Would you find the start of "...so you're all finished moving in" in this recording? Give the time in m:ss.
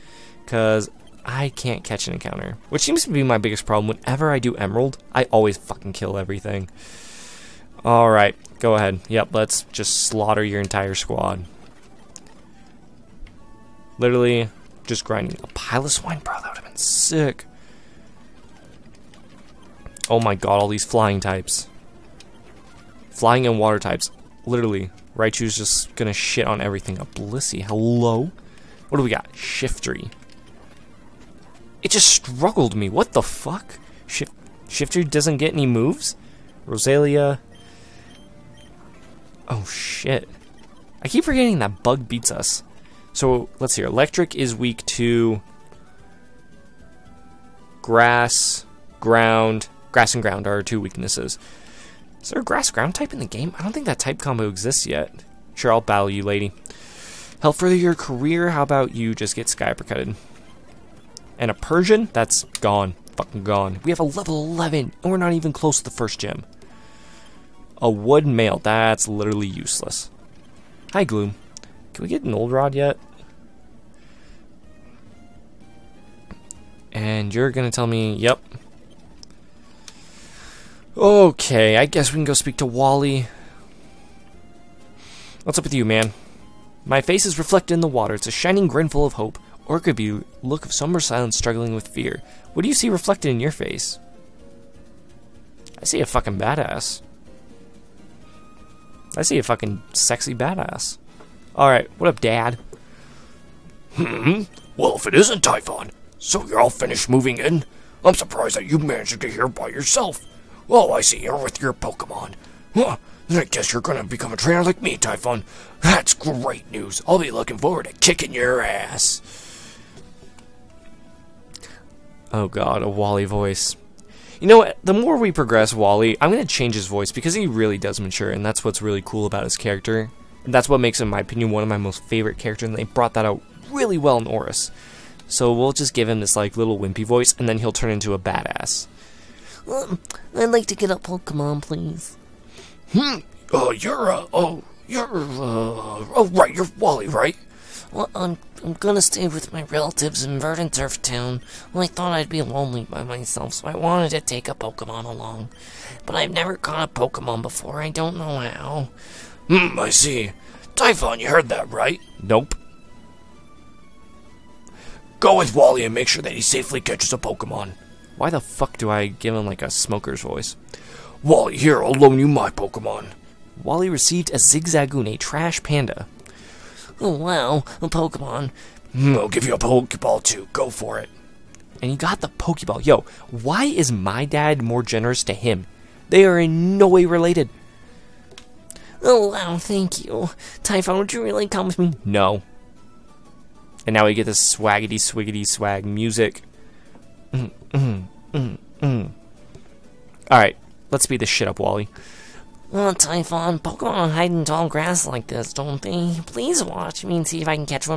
1:46.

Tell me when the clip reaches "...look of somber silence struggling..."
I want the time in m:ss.
1:30.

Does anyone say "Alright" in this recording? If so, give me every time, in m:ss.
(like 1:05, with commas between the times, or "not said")
0:07, 1:41, 3:20.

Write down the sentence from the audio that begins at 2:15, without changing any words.
So we'll just give him this like little wimpy voice, and then he'll turn into a badass.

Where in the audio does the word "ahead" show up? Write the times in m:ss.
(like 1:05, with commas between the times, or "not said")
0:08.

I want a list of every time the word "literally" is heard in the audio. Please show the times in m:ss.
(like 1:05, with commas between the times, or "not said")
0:13, 0:24, 1:09.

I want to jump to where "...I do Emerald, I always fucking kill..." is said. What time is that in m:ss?
0:04.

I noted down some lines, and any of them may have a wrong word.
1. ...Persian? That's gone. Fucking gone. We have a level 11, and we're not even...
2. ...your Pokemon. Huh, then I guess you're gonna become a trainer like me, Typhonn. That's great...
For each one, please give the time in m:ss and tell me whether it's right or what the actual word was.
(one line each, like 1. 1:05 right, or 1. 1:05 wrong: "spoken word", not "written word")
1. 1:01 right
2. 1:51 right.